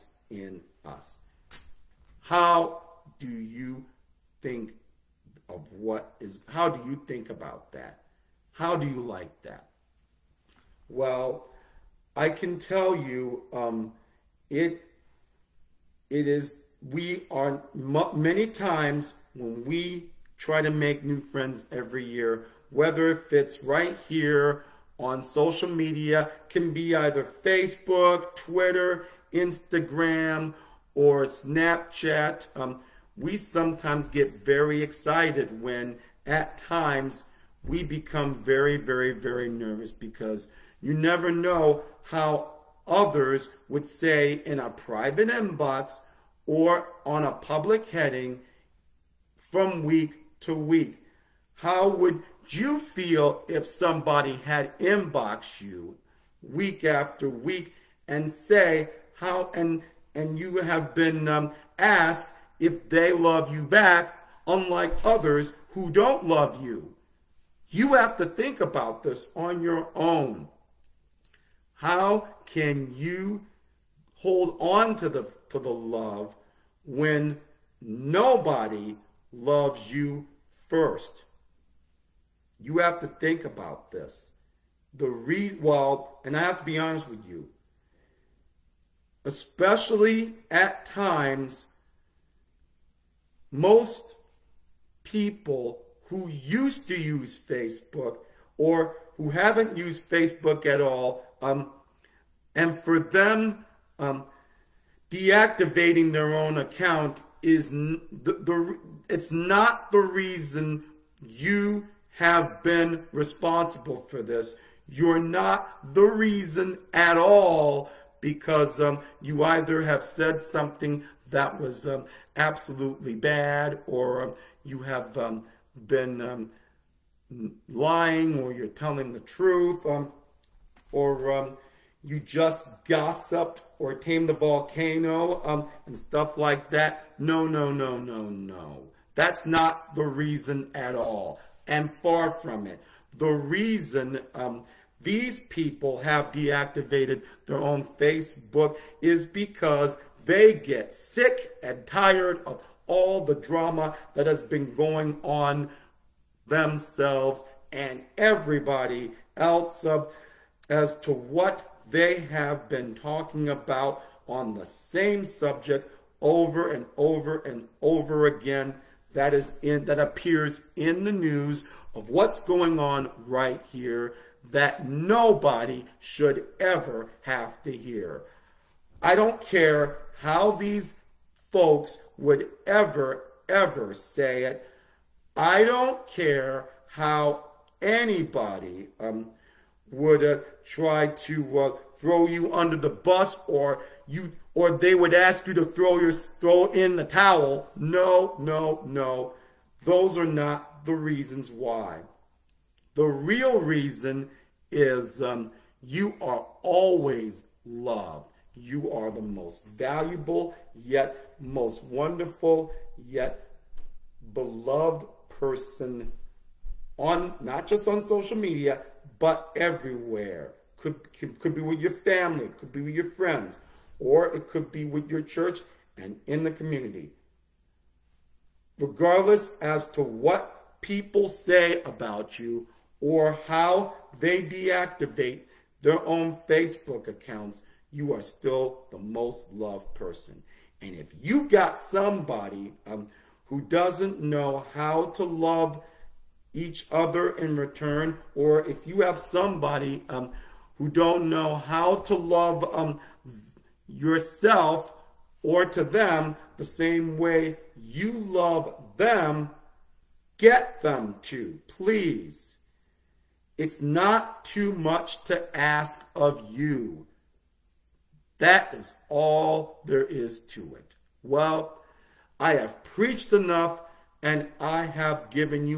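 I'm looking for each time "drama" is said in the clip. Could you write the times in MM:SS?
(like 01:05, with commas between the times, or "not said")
02:33.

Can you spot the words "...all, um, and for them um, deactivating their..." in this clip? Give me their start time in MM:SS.
01:40.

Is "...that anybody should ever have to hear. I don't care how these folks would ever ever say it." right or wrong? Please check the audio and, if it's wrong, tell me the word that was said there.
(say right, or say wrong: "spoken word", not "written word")
wrong: "nobody", not "anybody".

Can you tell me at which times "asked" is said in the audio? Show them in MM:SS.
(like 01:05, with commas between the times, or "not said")
01:01.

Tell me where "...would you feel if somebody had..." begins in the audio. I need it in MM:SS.
00:51.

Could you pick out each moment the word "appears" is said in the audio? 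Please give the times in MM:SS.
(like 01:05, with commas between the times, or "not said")
02:49.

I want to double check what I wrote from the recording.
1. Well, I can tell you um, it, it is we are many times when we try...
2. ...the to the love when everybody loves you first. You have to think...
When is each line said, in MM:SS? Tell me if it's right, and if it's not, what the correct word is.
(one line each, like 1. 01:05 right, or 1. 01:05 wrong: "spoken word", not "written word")
1. 00:10 right
2. 01:15 wrong: "nobody", not "everybody".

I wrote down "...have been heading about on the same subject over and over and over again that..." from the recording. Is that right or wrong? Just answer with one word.
wrong.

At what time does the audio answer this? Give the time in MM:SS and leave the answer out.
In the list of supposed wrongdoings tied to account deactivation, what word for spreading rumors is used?
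02:12.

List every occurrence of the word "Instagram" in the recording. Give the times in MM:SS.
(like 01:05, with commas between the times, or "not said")
00:29.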